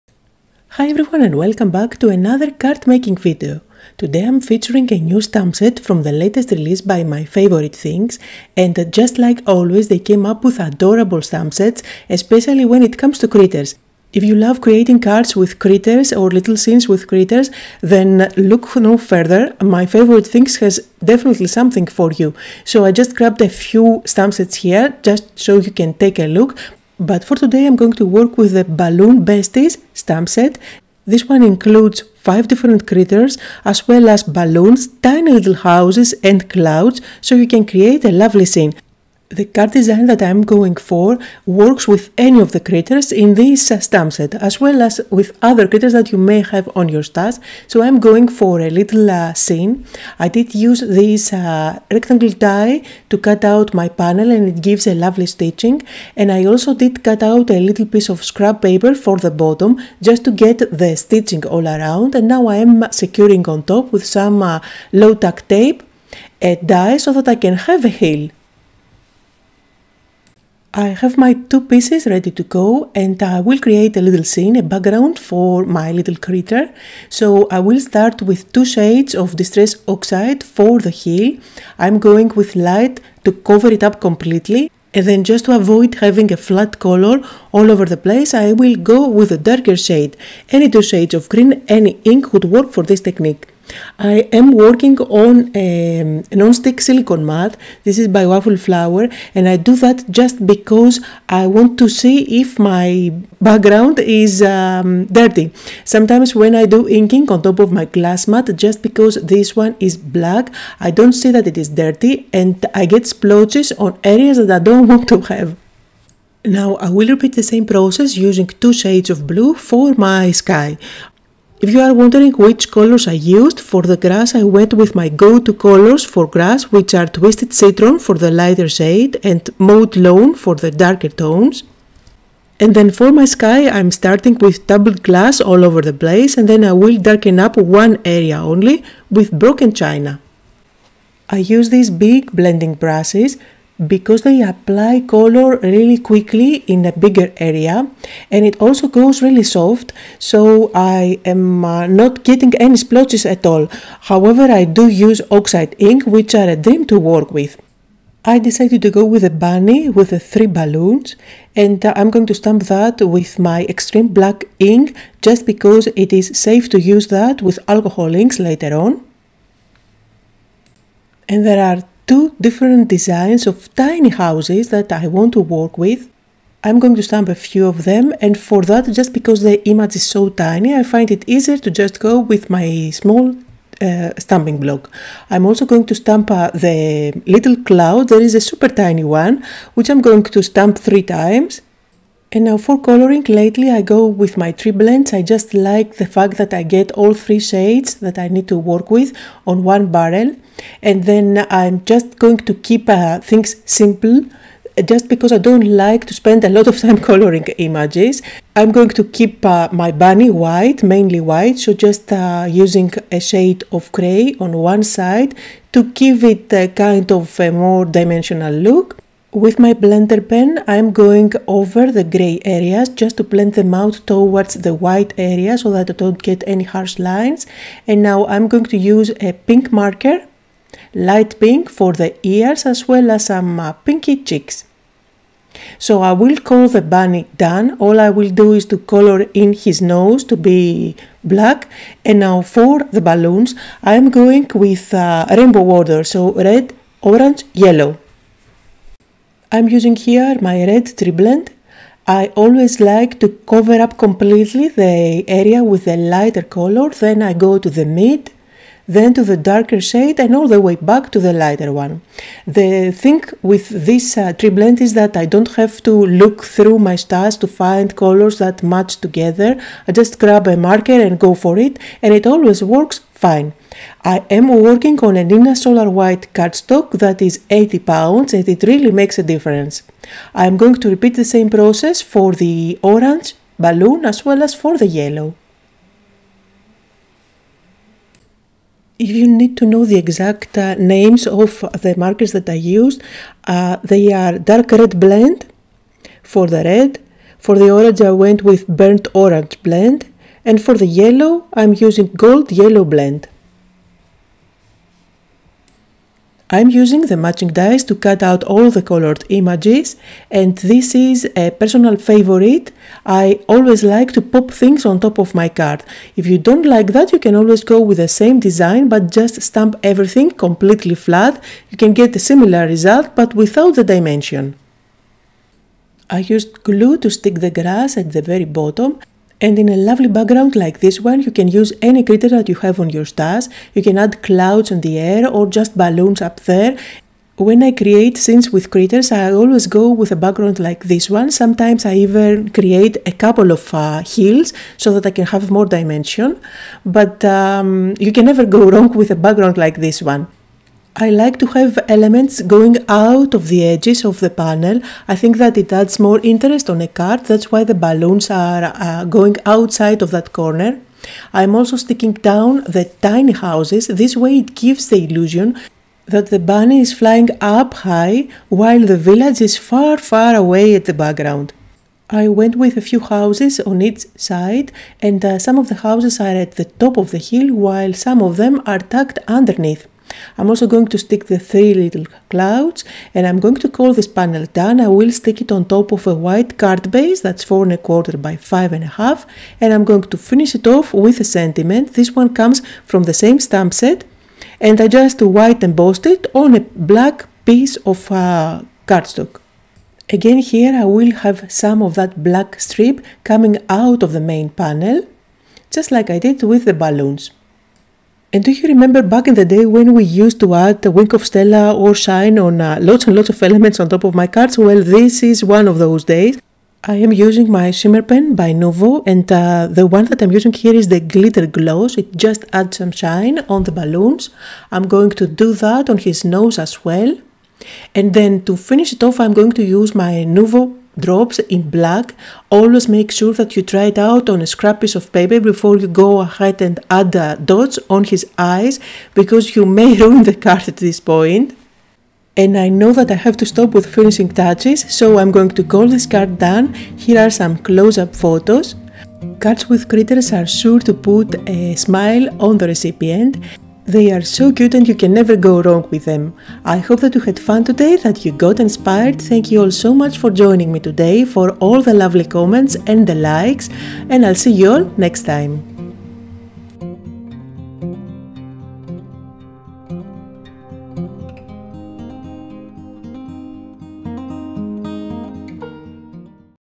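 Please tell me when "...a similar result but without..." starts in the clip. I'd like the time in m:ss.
5:22.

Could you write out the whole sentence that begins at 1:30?
Any two shades of green, any ink would work for this technique.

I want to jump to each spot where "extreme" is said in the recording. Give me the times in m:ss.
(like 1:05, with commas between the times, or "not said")
2:43.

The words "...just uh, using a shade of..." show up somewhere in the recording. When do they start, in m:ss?
3:31.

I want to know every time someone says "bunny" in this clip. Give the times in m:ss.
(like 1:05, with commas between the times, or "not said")
2:39, 3:29, 3:56, 6:06.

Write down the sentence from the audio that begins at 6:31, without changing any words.
This one comes from the same stamp set and I just white embossed it on a black piece of uh, cardstock.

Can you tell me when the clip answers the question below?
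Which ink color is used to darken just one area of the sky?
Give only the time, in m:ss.
2:19.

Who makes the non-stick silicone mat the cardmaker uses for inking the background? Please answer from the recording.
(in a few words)
Waffle Flower.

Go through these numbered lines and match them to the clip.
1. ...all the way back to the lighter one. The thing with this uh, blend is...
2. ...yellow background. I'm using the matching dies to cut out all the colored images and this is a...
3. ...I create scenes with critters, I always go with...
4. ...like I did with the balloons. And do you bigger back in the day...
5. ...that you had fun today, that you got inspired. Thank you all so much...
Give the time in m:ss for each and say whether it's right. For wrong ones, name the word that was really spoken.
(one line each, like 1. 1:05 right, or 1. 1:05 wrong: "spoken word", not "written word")
1. 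4:20 right
2. 5:02 wrong: "blend", not "background"
3. 5:37 right
4. 6:45 wrong: "remember", not "bigger"
5. 7:37 right.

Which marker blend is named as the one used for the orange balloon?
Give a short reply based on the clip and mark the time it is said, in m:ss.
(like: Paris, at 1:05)
burnt orange blend, at 4:58.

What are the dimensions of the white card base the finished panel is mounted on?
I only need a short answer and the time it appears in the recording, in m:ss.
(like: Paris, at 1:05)
4 1/4 by 5 1/2, at 6:27.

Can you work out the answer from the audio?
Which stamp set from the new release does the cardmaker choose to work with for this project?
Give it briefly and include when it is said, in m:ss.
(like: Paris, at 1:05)
Balloon Besties, at 0:28.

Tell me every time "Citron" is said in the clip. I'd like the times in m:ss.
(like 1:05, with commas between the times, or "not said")
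2:07.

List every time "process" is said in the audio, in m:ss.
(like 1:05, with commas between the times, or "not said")
1:57, 4:41.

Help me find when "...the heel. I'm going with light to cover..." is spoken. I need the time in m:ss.
1:20.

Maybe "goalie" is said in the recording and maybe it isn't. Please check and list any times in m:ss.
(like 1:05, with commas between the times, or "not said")
not said.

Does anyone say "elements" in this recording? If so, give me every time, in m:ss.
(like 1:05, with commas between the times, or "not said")
5:51, 6:53.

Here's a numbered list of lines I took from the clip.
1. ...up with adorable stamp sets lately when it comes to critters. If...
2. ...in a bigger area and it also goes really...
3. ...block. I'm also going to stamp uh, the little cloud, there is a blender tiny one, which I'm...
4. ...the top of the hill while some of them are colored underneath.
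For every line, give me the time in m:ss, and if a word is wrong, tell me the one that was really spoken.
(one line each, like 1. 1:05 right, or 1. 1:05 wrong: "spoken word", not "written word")
1. 0:10 wrong: "especially", not "lately"
2. 2:26 right
3. 3:04 wrong: "super", not "blender"
4. 6:16 wrong: "tucked", not "colored".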